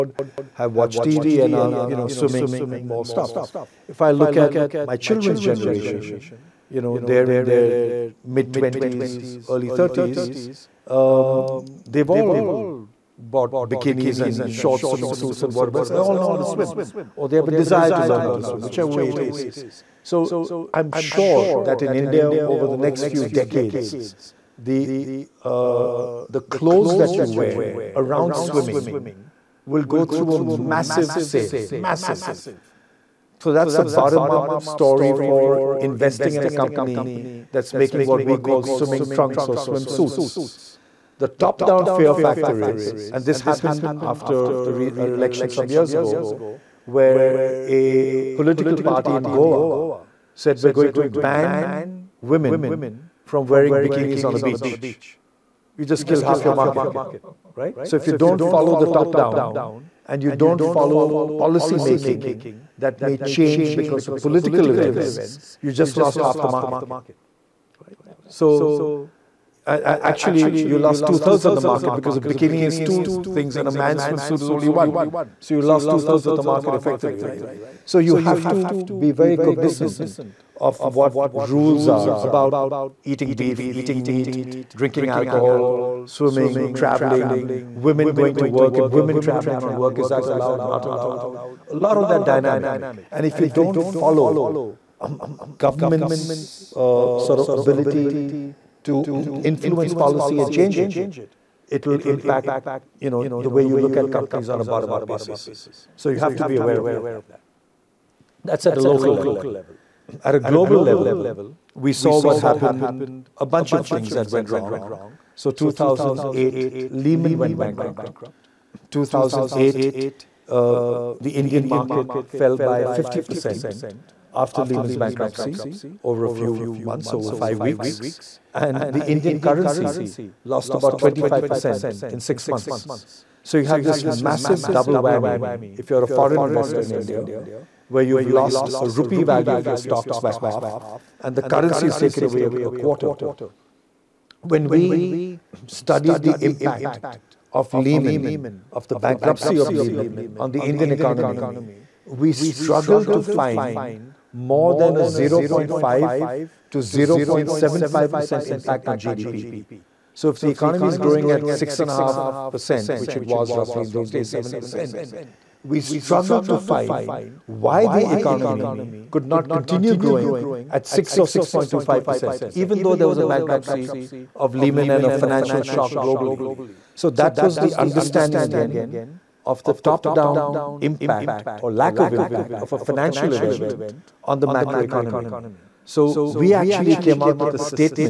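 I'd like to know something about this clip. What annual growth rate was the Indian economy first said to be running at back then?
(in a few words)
6.5%.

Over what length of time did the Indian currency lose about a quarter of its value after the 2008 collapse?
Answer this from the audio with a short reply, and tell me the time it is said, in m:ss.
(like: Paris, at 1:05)
six months, at 2:12.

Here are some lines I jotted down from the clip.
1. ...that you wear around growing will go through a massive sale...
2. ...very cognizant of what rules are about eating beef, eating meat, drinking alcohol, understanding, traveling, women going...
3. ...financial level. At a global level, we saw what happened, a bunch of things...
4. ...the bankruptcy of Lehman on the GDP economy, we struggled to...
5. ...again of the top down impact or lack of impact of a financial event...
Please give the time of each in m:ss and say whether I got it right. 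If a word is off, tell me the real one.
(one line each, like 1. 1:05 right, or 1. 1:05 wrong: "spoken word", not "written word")
1. 0:26 wrong: "swimming", not "growing"
2. 1:19 wrong: "swimming", not "understanding"
3. 1:48 wrong: "local", not "financial"
4. 2:28 wrong: "Indian", not "GDP"
5. 2:58 right.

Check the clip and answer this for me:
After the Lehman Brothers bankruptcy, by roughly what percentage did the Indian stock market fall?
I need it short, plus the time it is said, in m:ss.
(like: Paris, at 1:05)
50%, at 2:02.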